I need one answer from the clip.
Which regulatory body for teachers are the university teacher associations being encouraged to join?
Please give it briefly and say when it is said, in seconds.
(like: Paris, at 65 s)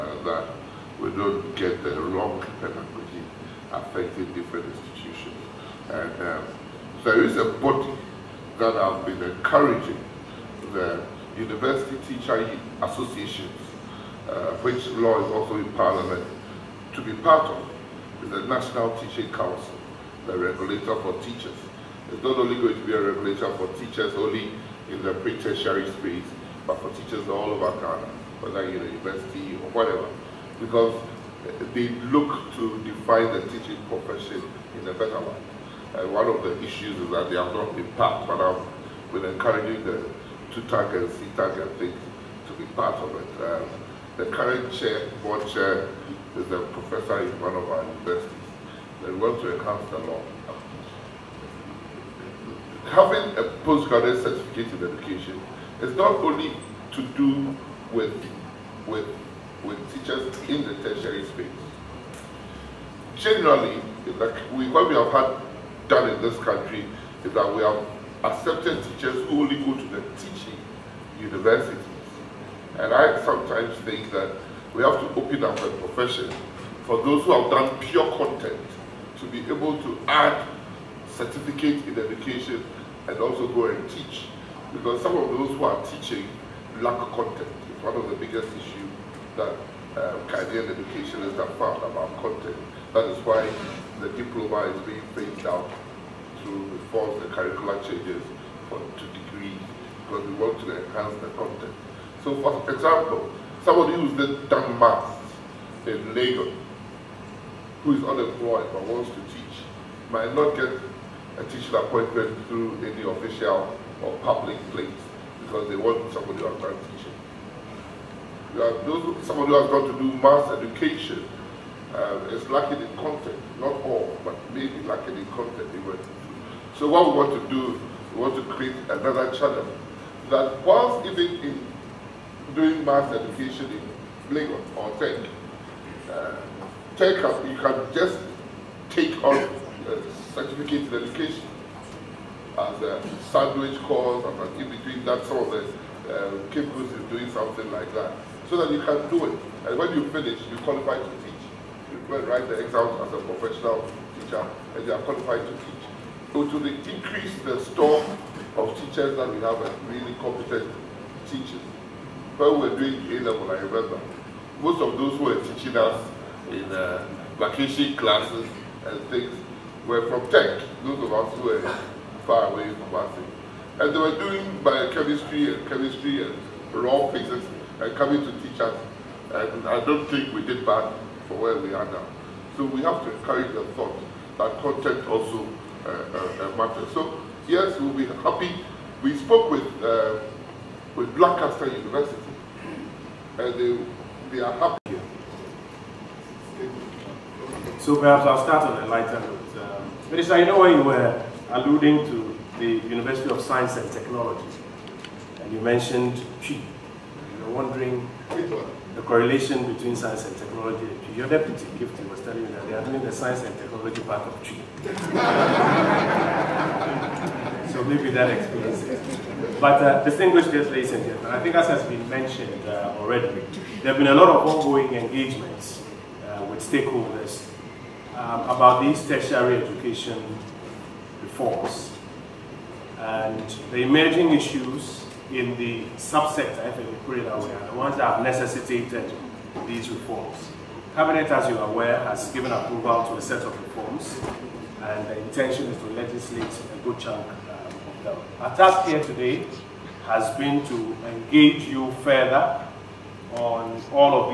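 National Teaching Council, at 18 s.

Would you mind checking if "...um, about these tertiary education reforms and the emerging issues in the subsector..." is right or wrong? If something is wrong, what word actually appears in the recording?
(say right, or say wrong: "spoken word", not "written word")
right.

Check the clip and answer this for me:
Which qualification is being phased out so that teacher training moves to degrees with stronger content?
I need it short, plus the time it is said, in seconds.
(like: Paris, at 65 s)
diploma, at 94 s.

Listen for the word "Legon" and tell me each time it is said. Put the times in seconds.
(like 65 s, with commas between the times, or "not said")
106 s, 134 s.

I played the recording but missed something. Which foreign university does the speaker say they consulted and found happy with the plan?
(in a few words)
Lancaster University.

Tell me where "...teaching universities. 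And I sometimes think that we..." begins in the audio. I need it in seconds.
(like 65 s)
70 s.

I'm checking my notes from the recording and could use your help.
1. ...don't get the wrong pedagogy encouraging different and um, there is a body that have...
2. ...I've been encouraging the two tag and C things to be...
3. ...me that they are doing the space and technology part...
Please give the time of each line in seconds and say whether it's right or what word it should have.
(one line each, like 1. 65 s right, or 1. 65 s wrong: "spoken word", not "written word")
1. 1 s wrong: "affecting", not "encouraging"
2. 38 s right
3. 212 s wrong: "science", not "space".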